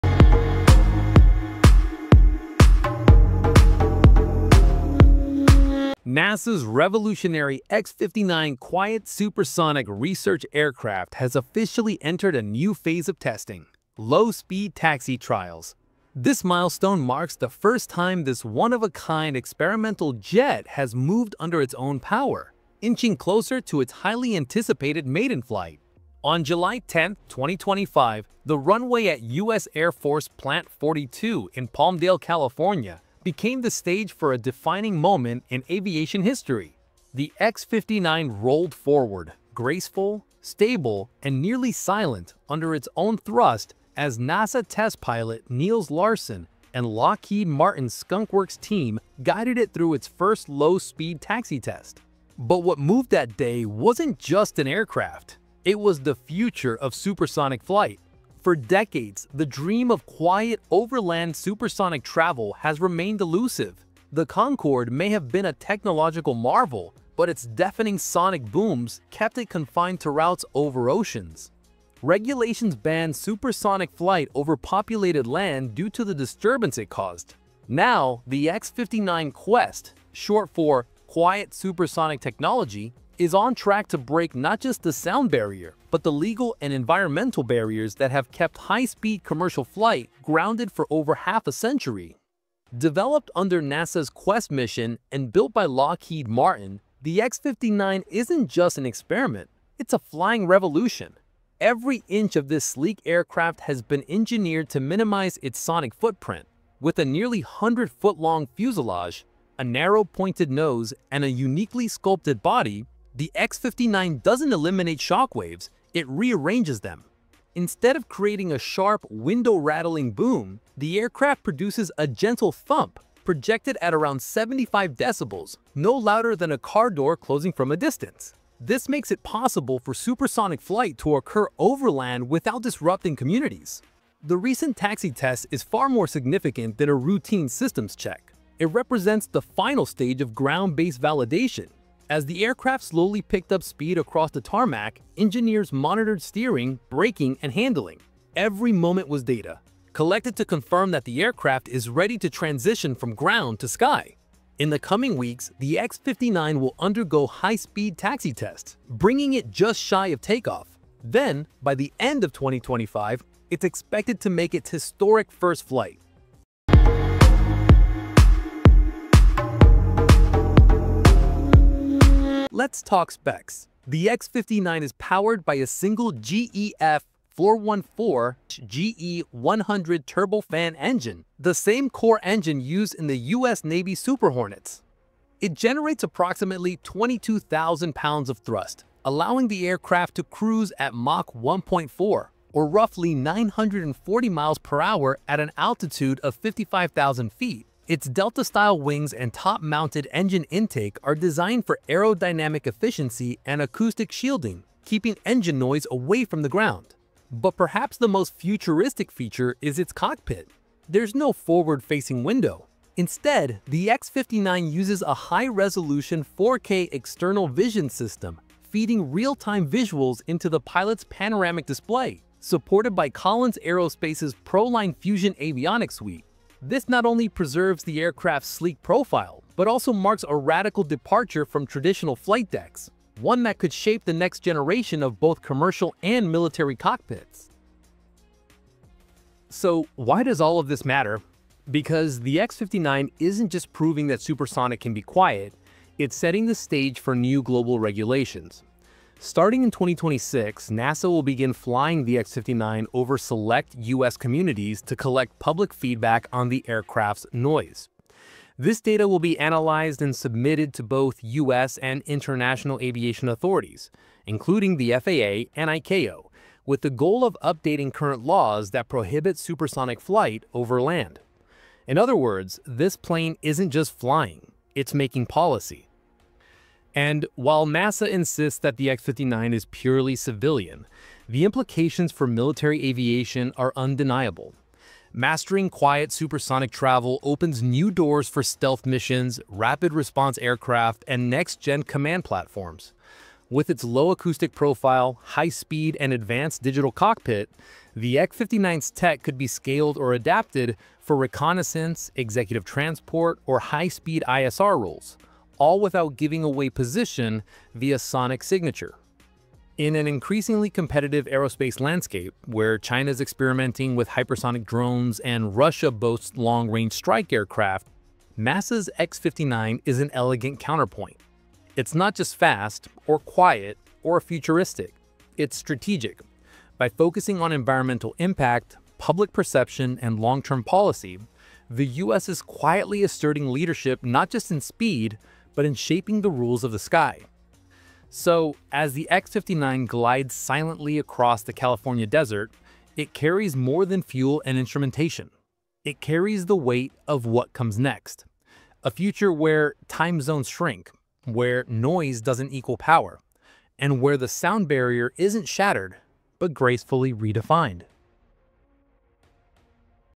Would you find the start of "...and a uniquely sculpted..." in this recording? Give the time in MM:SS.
01:51.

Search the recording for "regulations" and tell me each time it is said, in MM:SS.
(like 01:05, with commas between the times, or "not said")
01:12, 04:07.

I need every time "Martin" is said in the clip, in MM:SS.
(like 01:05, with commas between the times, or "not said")
00:47, 01:36.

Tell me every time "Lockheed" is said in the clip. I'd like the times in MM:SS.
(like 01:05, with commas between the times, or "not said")
00:46, 01:35.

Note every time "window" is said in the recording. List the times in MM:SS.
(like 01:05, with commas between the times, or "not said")
01:59, 03:32.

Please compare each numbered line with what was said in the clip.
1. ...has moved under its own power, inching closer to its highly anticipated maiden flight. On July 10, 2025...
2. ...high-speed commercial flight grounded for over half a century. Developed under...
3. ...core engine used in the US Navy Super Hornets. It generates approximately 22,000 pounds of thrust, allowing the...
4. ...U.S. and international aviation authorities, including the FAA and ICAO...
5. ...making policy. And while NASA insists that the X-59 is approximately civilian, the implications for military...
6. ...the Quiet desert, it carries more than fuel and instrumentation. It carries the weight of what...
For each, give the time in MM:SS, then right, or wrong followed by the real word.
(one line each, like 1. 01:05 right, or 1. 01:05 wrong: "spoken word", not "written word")
1. 00:20 right
2. 01:28 right
3. 03:01 right
4. 04:21 right
5. 04:34 wrong: "purely", not "approximately"
6. 05:41 wrong: "California", not "Quiet".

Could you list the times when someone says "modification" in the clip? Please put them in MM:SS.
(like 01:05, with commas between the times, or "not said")
not said.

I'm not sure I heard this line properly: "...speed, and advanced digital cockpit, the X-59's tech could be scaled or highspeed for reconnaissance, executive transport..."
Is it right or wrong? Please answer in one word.
wrong.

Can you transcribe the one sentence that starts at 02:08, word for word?
This makes it possible for supersonic flight to occur overland without disrupting communities.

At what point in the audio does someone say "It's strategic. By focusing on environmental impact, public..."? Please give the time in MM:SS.
05:25.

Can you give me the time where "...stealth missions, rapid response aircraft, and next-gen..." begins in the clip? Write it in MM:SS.
04:48.